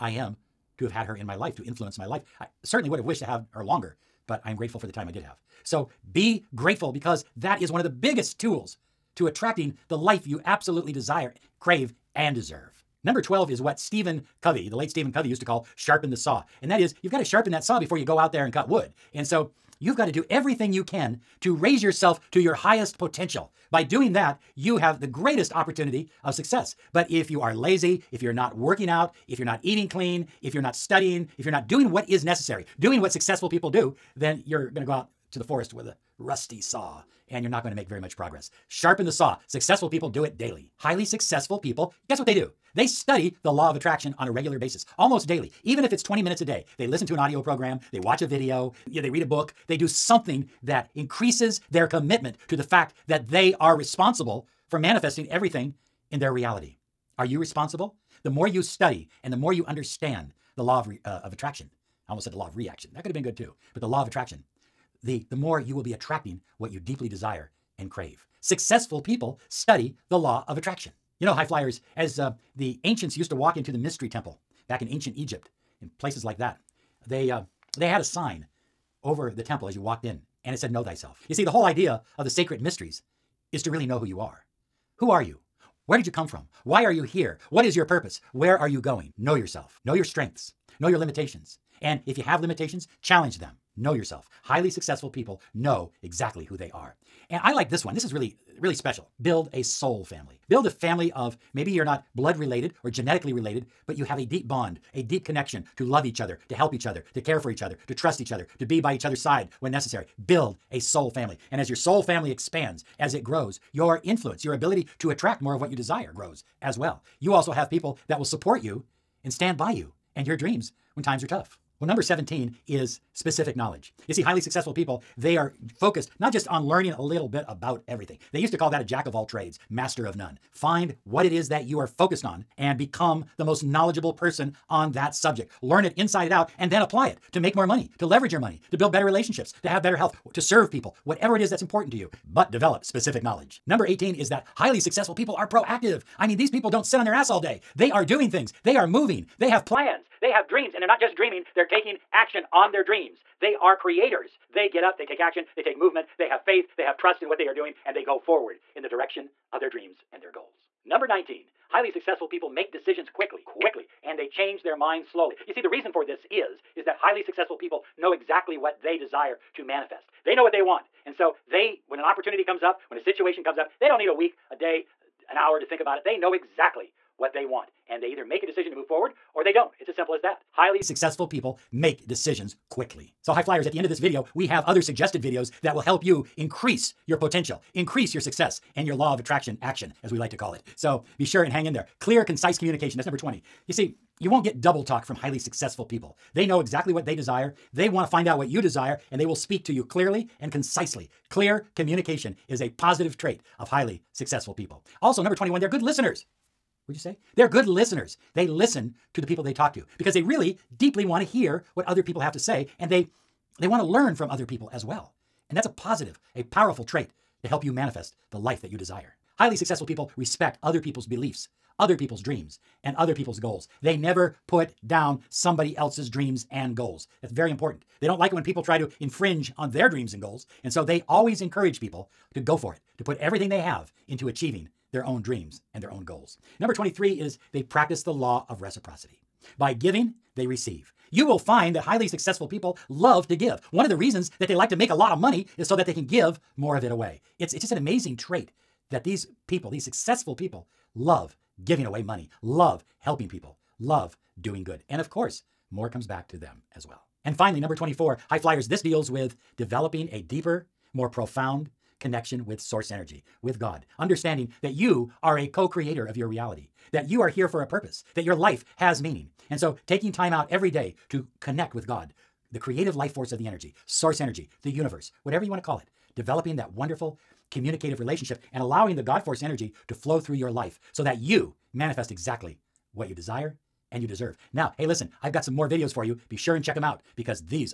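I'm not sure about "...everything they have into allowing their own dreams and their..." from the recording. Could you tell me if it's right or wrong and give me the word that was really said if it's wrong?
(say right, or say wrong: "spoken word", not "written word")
wrong: "achieving", not "allowing".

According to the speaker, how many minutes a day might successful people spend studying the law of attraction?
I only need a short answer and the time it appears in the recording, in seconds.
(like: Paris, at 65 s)
20, at 46 s.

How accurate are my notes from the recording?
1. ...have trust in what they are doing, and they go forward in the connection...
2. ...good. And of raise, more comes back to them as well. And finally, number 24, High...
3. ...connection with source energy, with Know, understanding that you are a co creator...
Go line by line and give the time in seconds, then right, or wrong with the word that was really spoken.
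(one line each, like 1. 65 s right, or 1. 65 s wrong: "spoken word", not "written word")
1. 156 s wrong: "direction", not "connection"
2. 254 s wrong: "course", not "raise"
3. 261 s wrong: "God", not "Know".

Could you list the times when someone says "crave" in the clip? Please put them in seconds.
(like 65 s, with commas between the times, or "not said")
11 s, 67 s.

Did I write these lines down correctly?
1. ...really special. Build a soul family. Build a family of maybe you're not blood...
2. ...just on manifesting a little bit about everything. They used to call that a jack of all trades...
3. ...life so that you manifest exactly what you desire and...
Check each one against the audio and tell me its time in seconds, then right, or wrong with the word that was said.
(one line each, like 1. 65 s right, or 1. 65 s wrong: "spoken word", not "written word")
1. 98 s right
2. 126 s wrong: "learning", not "manifesting"
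3. 280 s right.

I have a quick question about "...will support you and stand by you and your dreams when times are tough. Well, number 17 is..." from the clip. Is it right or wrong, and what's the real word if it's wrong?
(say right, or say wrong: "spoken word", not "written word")
right.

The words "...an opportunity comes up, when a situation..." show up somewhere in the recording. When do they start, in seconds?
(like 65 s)
171 s.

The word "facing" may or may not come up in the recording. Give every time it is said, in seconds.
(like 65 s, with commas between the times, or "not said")
not said.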